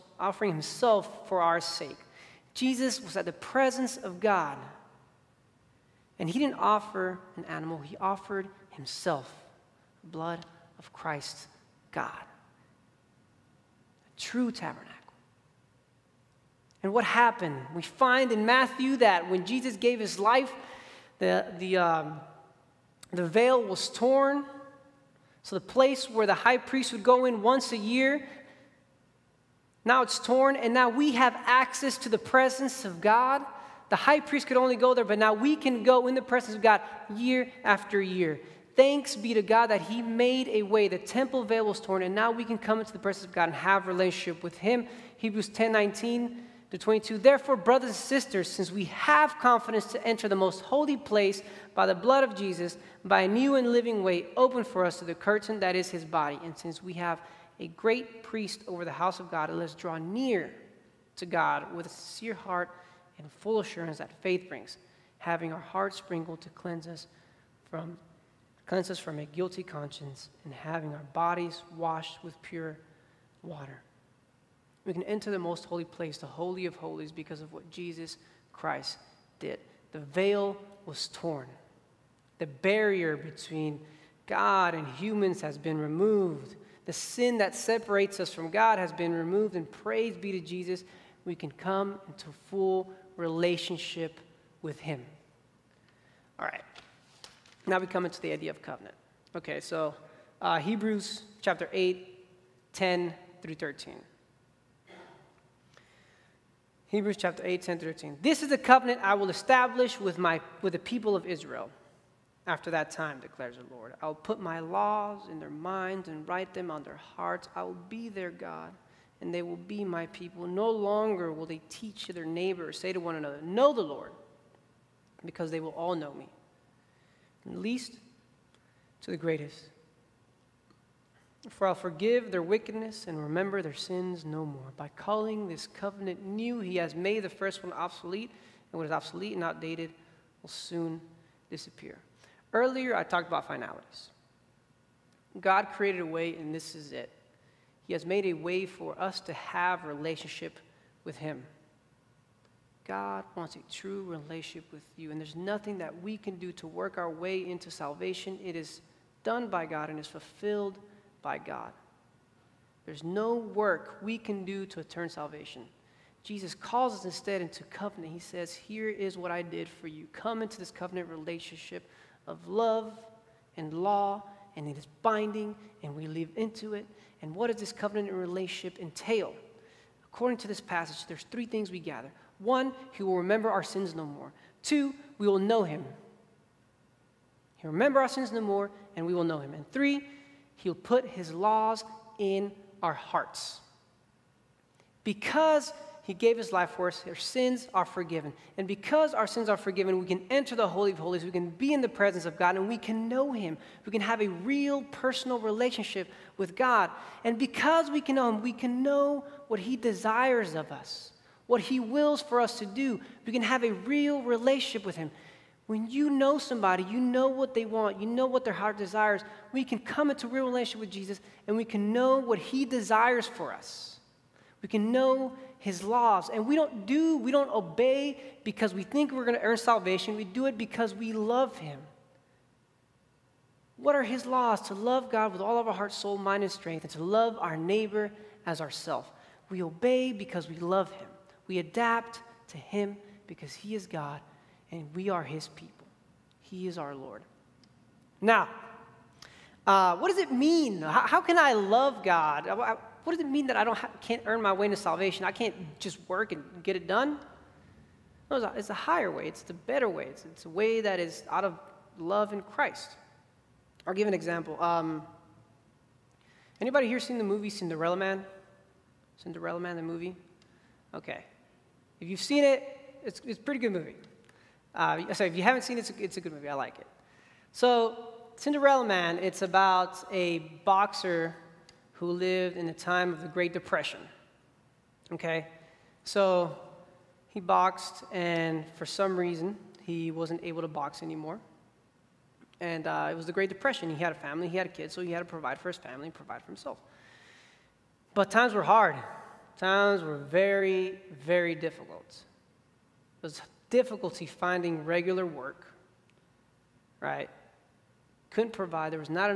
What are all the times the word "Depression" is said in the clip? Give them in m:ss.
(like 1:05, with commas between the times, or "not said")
4:43, 4:53.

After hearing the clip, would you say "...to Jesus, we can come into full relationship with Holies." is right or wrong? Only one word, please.
wrong.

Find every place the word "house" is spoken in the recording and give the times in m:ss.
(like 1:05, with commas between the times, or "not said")
0:58.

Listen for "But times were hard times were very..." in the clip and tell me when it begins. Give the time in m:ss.
4:58.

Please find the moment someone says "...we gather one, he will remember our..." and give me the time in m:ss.
3:01.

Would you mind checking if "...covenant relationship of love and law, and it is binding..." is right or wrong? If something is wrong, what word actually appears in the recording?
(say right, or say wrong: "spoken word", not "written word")
right.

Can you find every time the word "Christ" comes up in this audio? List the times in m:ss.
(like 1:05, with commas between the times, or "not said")
0:10, 1:18, 4:22.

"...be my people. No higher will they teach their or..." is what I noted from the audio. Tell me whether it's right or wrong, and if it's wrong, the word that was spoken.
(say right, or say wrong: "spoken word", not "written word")
wrong: "longer", not "higher".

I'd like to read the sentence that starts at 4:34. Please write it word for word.
Uh, sorry, if you haven't seen it, it's a, it's a good movie.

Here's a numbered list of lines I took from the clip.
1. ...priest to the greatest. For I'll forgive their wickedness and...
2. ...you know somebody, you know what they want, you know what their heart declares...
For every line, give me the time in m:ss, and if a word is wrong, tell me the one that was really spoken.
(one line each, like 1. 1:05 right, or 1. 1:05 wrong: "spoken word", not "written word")
1. 2:07 wrong: "least", not "priest"
2. 3:35 wrong: "desires", not "declares".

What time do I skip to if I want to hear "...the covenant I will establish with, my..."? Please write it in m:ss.
1:48.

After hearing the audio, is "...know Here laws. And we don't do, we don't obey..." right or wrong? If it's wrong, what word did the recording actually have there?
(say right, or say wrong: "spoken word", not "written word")
wrong: "His", not "Here".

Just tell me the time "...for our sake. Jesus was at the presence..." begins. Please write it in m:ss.
0:01.